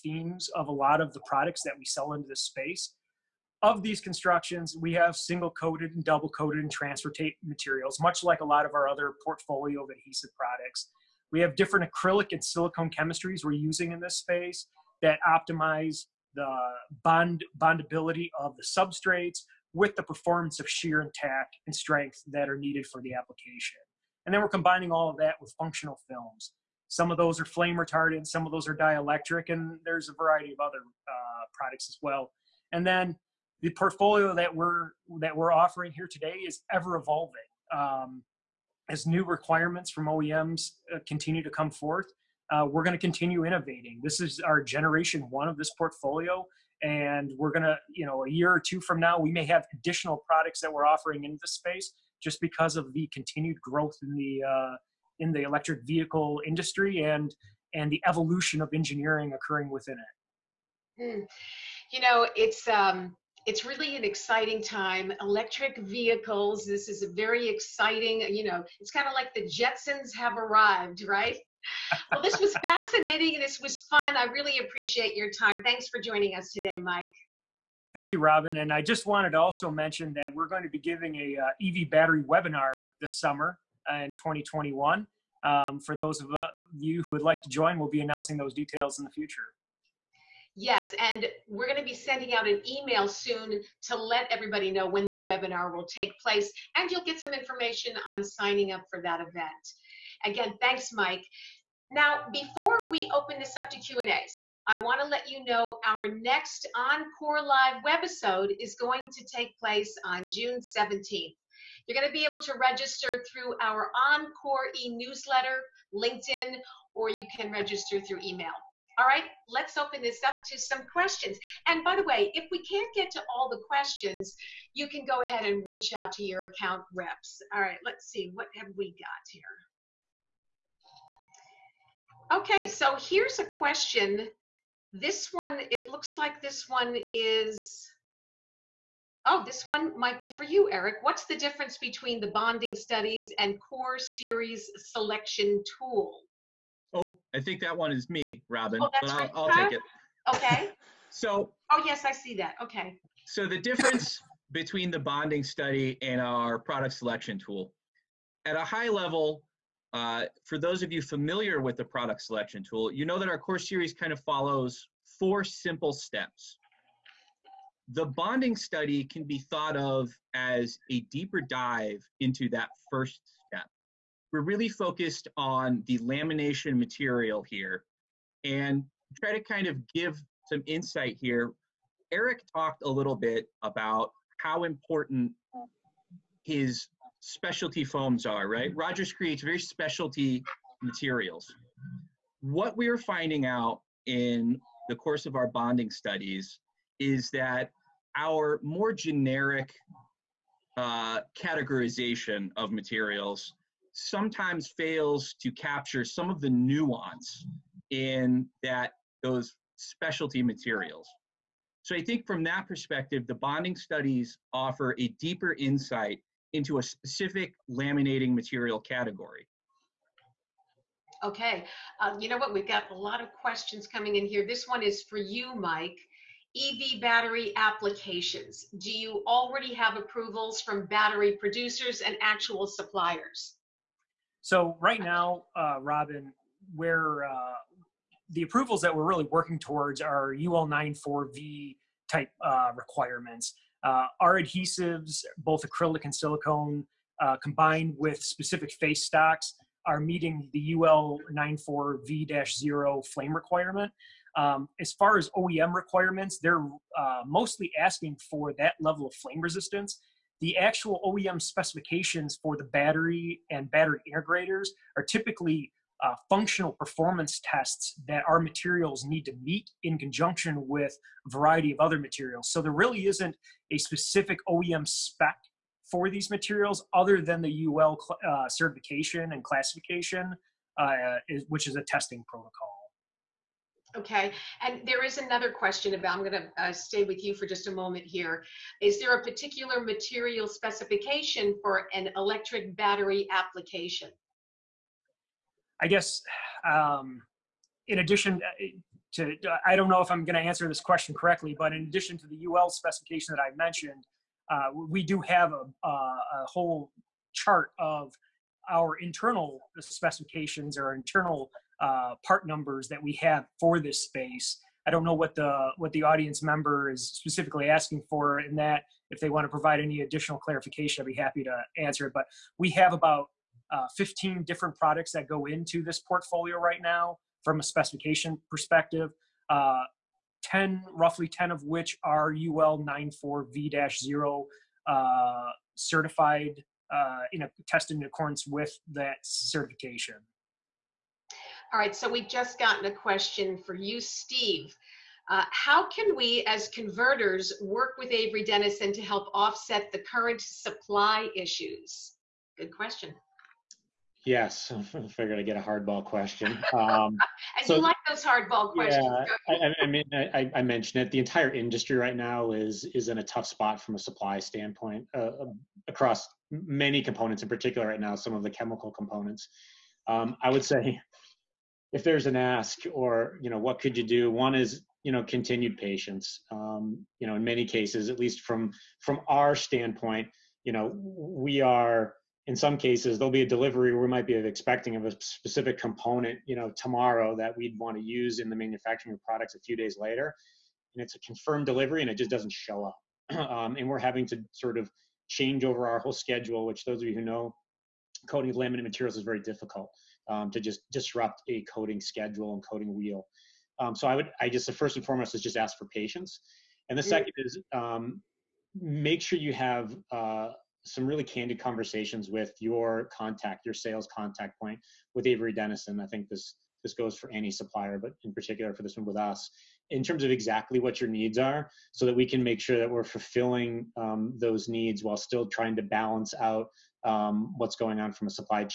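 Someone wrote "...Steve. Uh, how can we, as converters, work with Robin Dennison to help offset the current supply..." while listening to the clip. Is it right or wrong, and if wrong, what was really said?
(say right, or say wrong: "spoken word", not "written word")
wrong: "Avery", not "Robin".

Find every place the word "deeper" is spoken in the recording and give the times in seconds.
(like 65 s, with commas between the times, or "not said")
171 s, 215 s.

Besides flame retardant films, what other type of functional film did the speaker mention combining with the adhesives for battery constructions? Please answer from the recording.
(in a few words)
dielectric.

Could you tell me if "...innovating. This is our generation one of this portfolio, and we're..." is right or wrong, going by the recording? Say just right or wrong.
right.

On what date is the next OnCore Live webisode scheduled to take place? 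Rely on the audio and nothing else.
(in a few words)
June 17th.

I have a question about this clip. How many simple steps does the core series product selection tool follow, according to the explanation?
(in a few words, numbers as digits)
4.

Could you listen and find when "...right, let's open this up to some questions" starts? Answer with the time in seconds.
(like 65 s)
119 s.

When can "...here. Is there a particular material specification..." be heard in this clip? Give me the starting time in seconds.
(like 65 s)
288 s.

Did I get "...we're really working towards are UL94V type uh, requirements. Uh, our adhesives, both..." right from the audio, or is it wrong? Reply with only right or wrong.
right.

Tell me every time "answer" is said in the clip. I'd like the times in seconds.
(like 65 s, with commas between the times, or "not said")
300 s, 321 s.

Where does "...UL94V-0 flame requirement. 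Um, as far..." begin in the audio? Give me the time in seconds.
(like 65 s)
250 s.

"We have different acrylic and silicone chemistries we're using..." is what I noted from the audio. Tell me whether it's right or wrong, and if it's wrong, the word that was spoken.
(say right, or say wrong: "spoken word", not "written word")
right.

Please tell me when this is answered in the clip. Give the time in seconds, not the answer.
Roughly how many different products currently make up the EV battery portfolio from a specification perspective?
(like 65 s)
323 s.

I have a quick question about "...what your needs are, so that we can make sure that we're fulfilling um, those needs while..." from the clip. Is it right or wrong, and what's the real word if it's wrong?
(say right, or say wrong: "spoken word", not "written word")
right.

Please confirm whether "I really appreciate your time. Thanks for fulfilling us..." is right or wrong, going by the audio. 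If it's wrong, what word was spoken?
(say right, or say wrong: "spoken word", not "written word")
wrong: "joining", not "fulfilling".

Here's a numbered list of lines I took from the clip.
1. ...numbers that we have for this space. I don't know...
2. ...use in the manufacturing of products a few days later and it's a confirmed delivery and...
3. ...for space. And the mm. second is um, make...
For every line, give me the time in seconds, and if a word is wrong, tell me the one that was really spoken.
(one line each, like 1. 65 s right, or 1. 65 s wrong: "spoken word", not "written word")
1. 312 s right
2. 388 s right
3. 405 s wrong: "patience", not "space".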